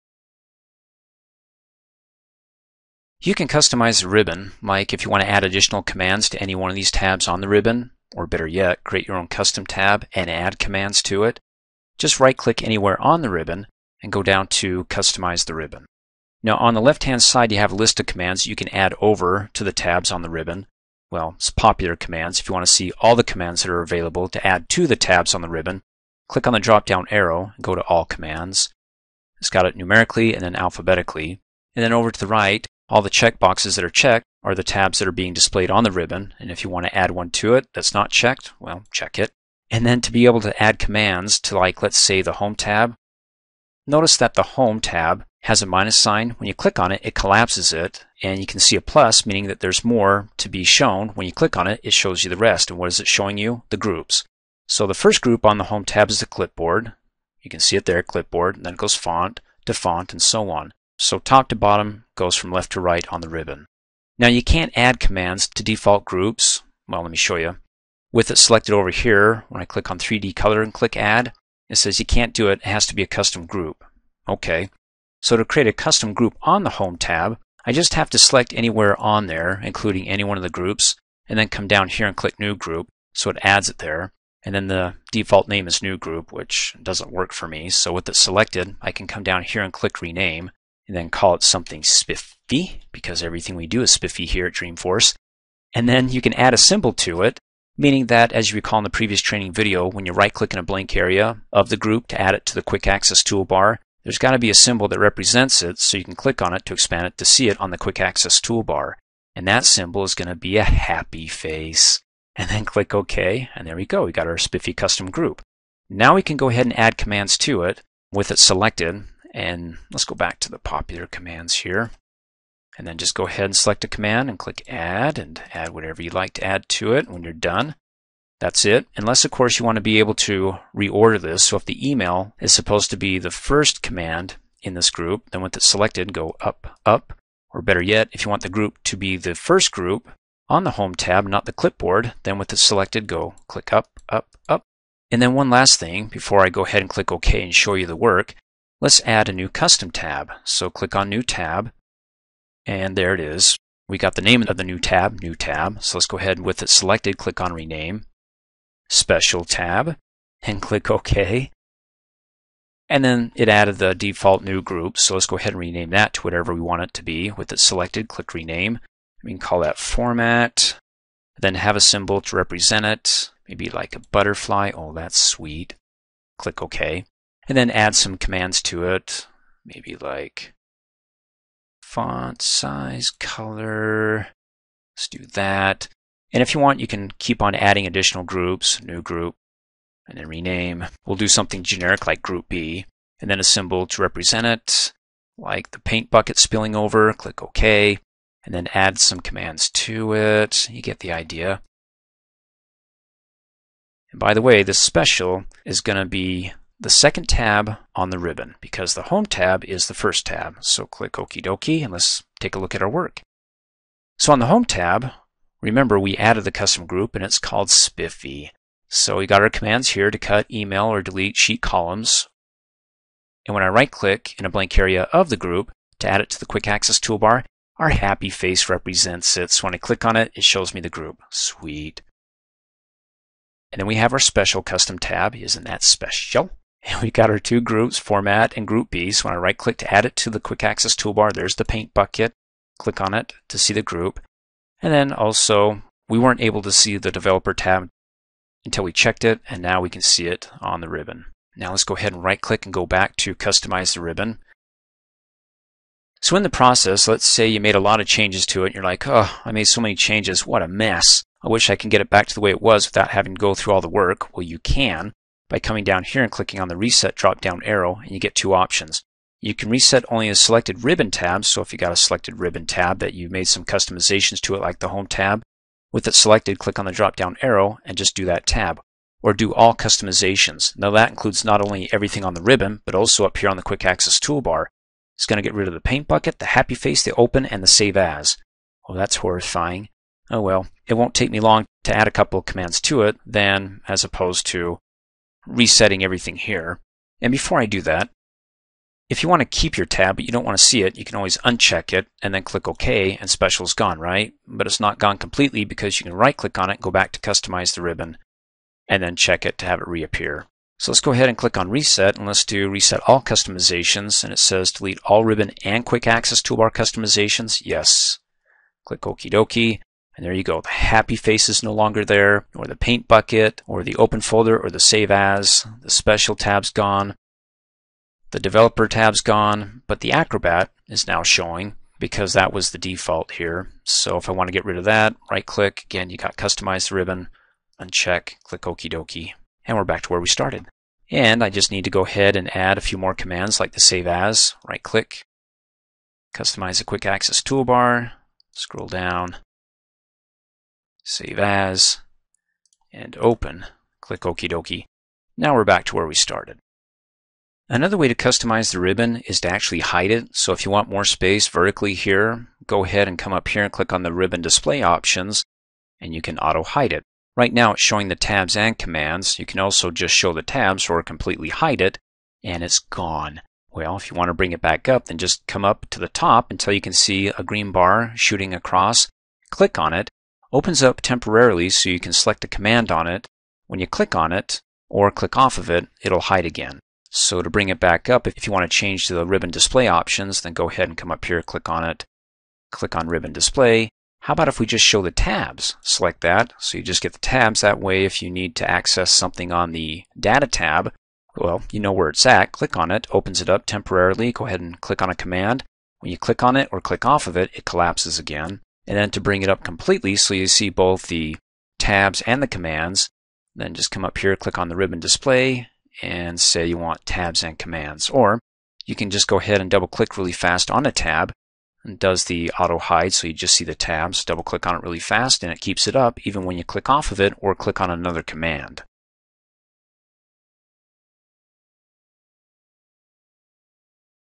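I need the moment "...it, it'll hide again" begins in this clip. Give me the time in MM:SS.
06:25.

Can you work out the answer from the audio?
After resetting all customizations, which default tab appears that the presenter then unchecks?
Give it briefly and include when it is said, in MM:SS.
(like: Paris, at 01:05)
Acrobat, at 05:30.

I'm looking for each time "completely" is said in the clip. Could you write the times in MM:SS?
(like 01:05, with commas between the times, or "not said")
05:05, 06:11, 06:49.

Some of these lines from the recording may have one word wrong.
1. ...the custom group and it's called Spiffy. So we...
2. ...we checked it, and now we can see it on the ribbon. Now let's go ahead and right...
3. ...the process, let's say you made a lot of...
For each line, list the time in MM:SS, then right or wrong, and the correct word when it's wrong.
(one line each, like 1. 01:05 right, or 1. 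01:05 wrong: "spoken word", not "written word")
1. 03:36 right
2. 04:08 right
3. 04:16 right.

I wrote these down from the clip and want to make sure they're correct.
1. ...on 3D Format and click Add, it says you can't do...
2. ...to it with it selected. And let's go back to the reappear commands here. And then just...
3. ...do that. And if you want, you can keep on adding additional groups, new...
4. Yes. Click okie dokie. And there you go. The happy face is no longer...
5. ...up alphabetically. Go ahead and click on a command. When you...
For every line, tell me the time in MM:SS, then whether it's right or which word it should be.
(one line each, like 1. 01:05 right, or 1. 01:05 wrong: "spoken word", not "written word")
1. 01:09 wrong: "Color", not "Format"
2. 01:57 wrong: "popular", not "reappear"
3. 03:05 right
4. 05:17 right
5. 06:43 wrong: "temporarily", not "alphabetically".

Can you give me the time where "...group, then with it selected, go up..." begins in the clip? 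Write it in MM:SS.
02:14.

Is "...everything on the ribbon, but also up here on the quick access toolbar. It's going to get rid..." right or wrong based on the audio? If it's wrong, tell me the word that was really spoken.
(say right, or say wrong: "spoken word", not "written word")
right.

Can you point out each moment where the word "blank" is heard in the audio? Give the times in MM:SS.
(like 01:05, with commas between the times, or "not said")
01:40, 03:44.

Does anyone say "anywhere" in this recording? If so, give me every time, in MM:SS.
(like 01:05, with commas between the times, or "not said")
00:12, 01:18.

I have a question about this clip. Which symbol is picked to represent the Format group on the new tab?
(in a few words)
A butterfly.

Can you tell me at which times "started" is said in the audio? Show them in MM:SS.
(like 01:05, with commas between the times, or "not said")
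05:40, 05:56.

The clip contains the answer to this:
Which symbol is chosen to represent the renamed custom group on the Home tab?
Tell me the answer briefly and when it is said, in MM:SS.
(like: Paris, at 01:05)
A happy face, at 01:50.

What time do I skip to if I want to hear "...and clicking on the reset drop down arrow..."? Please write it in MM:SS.
04:26.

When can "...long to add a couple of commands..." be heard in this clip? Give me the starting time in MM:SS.
04:51.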